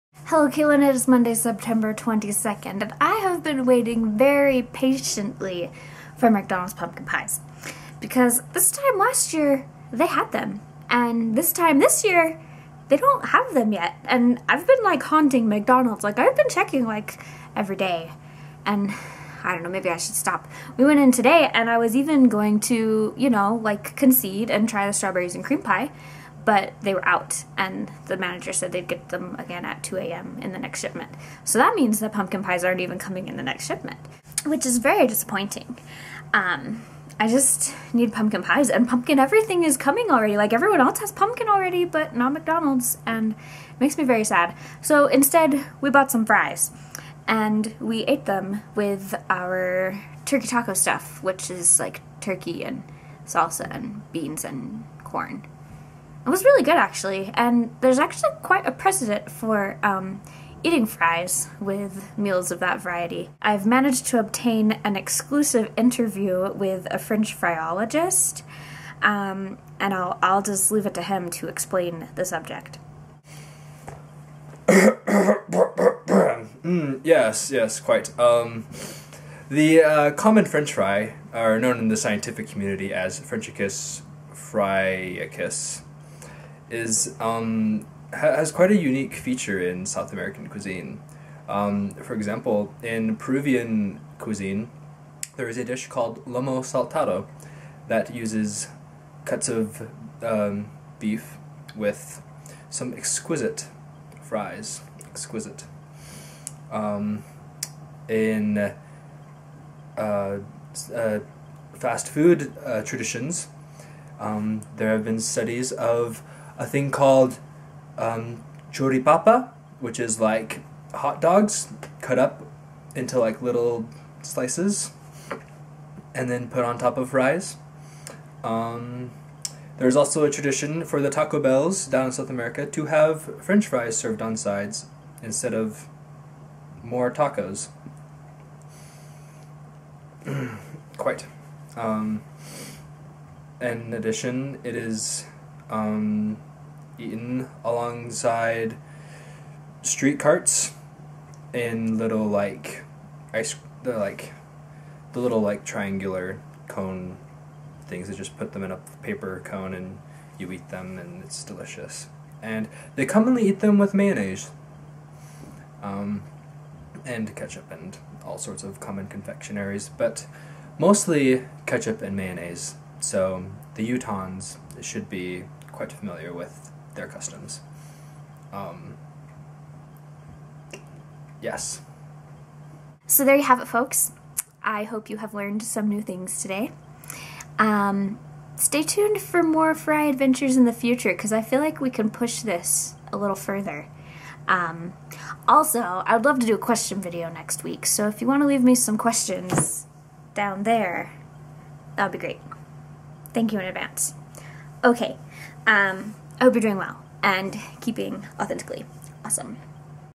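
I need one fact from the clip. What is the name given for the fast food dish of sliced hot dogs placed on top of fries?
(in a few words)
choripapa.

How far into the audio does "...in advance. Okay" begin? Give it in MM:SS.
03:23.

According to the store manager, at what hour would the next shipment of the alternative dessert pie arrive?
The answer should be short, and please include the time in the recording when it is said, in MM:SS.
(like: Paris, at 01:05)
2 a.m., at 00:29.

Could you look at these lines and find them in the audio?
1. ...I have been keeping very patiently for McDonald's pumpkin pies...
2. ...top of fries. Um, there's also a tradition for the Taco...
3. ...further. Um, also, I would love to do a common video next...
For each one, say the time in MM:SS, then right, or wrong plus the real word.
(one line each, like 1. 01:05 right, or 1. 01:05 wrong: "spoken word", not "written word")
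1. 00:03 wrong: "waiting", not "keeping"
2. 02:06 right
3. 03:13 wrong: "question", not "common".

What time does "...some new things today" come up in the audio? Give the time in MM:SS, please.
03:05.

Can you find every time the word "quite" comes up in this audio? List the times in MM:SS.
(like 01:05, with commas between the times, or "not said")
00:58, 01:17, 01:28, 02:20, 02:55.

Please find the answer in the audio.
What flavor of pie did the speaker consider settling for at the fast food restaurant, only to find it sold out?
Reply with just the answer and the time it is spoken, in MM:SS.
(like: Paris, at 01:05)
strawberries and cream, at 00:24.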